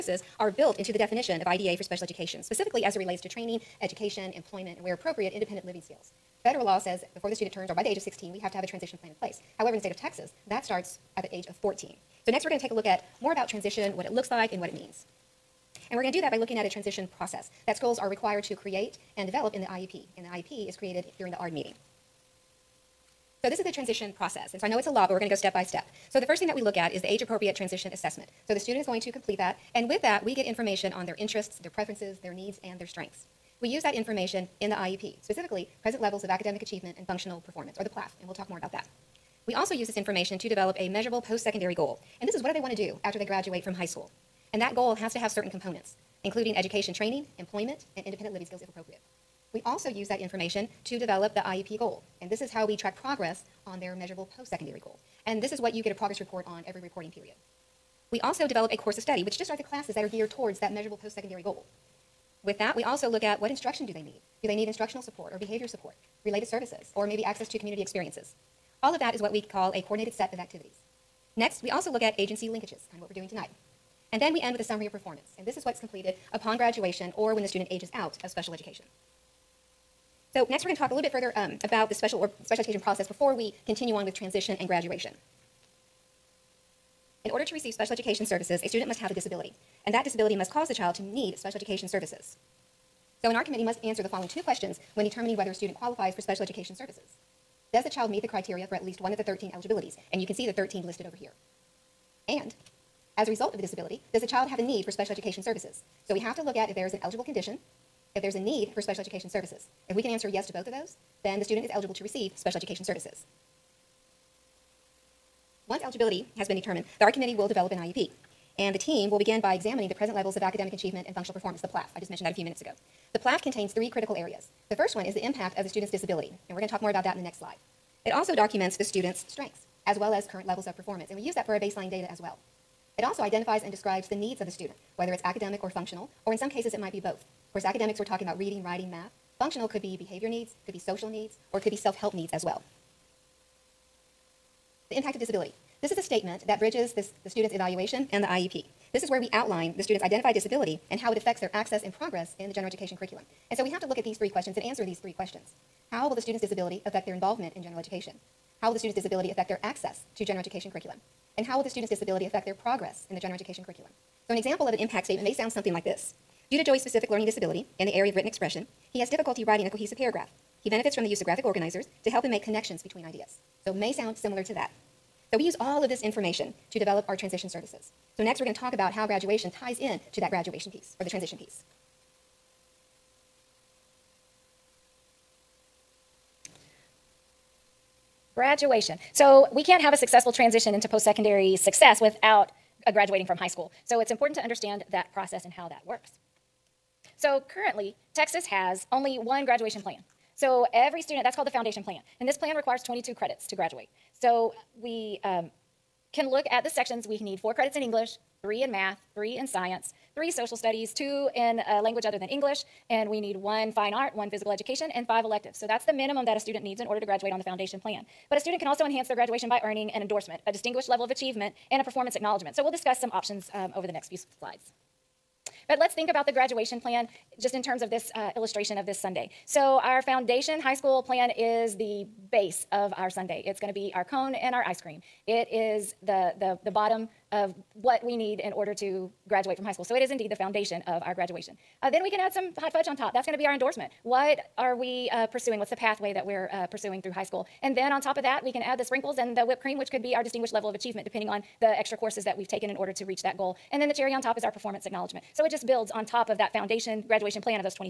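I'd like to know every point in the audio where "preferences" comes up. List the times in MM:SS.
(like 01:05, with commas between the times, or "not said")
00:31.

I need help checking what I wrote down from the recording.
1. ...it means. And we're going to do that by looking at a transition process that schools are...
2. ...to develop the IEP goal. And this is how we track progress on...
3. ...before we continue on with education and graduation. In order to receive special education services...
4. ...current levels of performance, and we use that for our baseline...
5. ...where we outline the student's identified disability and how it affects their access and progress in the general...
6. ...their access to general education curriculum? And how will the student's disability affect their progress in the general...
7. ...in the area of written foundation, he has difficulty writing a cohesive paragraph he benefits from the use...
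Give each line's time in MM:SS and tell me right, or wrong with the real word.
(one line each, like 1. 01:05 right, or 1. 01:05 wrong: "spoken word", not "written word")
1. 00:14 right
2. 00:50 right
3. 01:23 wrong: "transition", not "education"
4. 02:10 right
5. 02:29 right
6. 02:39 right
7. 02:47 wrong: "expression", not "foundation".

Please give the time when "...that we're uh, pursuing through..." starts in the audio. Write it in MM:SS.
04:06.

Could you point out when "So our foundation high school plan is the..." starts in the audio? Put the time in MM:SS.
03:49.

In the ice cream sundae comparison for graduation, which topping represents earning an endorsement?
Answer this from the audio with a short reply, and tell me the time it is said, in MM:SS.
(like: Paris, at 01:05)
hot fudge, at 04:02.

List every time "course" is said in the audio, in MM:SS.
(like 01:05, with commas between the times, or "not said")
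00:58, 02:17, 04:11.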